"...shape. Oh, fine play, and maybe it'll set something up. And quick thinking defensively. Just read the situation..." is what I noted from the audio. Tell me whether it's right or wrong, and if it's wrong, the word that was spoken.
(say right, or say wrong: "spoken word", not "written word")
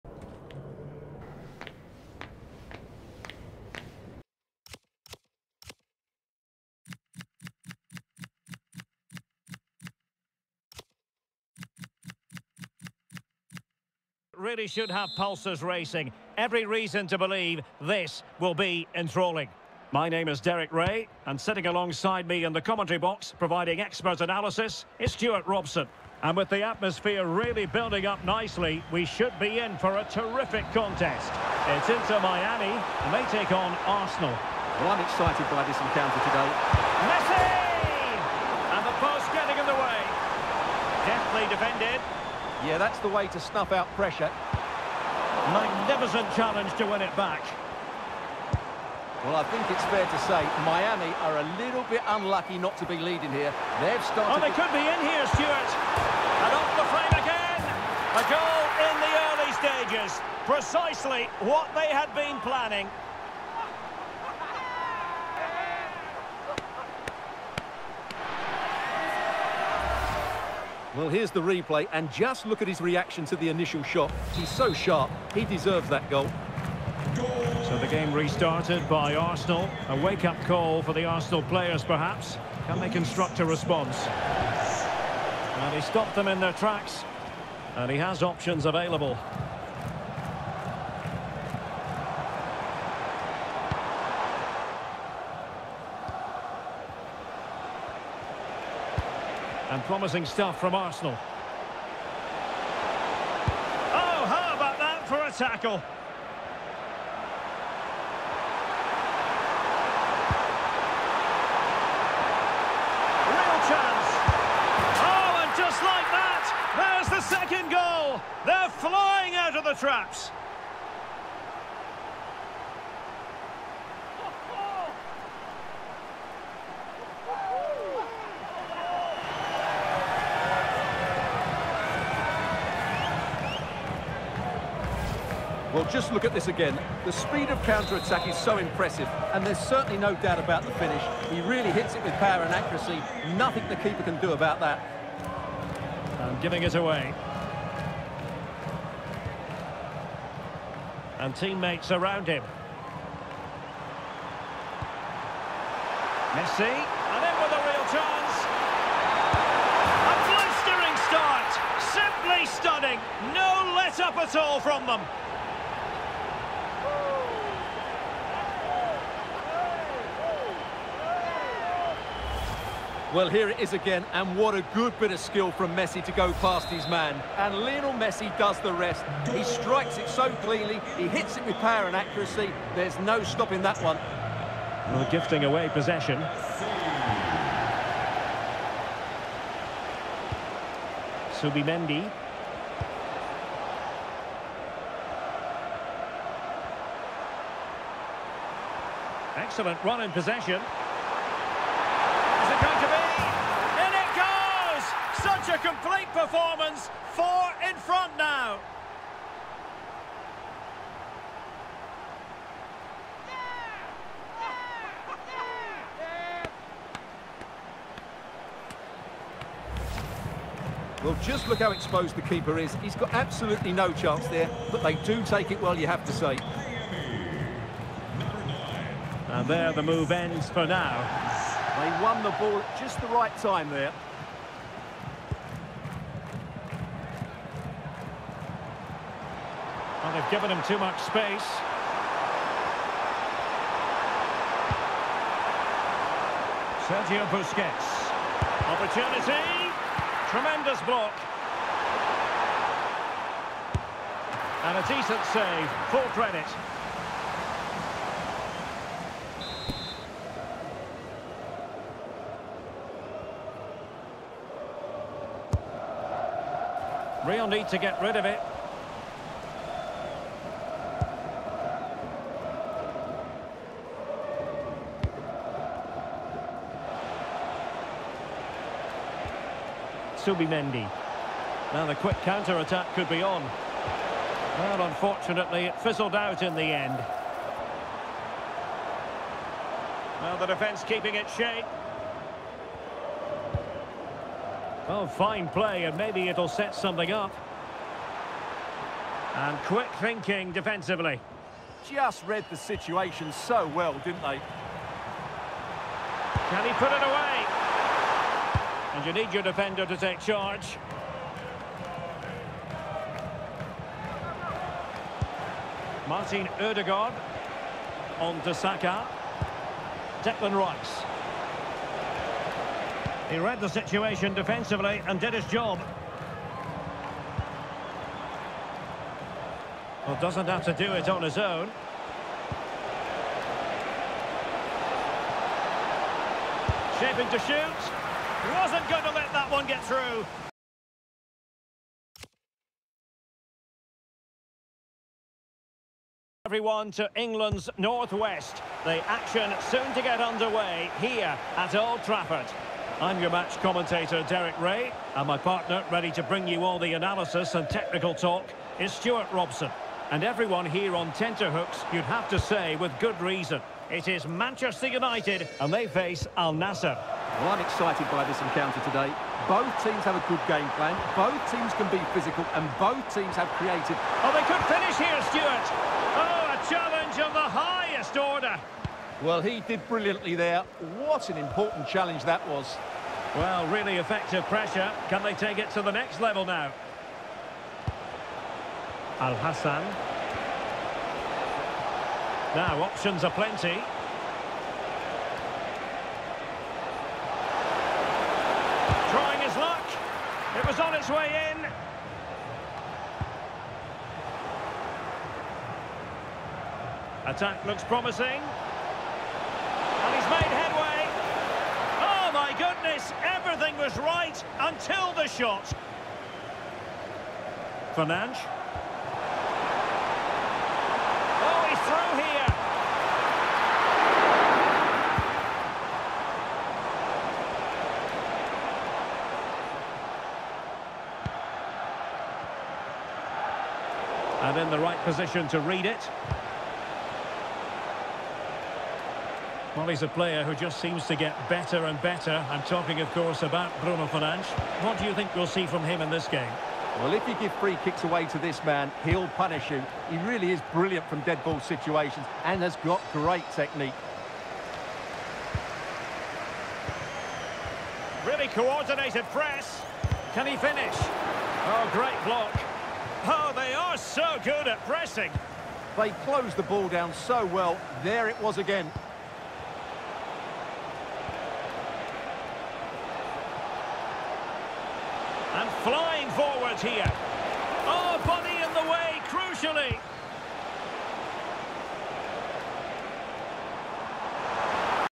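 right.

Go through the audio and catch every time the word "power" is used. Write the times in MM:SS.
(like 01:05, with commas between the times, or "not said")
02:22, 03:01.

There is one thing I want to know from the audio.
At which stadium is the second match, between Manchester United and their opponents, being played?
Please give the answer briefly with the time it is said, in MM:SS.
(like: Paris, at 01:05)
Old Trafford, at 05:51.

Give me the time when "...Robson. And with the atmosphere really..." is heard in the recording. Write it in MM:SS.
00:25.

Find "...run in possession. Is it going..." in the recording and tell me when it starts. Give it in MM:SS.
03:19.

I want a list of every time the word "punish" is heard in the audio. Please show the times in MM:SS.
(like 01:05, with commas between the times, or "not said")
07:29.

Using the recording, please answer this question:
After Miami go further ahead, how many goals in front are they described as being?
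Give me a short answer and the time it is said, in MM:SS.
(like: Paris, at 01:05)
4, at 03:27.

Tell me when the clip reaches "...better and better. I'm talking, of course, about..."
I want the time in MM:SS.
07:21.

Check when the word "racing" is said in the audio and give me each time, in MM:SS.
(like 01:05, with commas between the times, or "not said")
00:15.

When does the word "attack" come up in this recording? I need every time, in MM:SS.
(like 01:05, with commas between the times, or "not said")
02:17, 04:42, 06:47.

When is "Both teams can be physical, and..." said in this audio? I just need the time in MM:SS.
06:11.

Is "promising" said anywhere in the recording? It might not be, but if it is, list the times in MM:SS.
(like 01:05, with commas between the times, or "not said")
01:39, 06:47.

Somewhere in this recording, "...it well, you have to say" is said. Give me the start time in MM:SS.
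03:45.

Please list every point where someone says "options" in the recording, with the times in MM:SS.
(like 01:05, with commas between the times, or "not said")
01:28, 06:32.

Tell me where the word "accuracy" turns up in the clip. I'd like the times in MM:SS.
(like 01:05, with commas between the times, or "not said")
02:22, 03:01.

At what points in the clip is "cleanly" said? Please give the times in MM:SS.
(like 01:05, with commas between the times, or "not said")
03:00.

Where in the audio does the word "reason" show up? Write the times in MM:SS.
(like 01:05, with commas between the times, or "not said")
00:16, 06:03.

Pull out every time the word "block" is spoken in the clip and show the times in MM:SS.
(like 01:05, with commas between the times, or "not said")
04:10, 07:42.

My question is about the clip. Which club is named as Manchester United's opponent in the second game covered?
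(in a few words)
Al Nassr.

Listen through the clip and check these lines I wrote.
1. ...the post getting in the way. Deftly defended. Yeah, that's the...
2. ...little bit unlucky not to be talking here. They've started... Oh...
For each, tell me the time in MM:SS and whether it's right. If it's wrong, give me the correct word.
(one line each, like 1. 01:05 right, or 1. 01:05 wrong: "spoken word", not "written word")
1. 00:38 right
2. 00:51 wrong: "leading", not "talking".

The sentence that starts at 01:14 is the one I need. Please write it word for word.
He's so sharp, he deserves that goal.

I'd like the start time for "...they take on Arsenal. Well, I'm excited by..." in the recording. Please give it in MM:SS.
00:33.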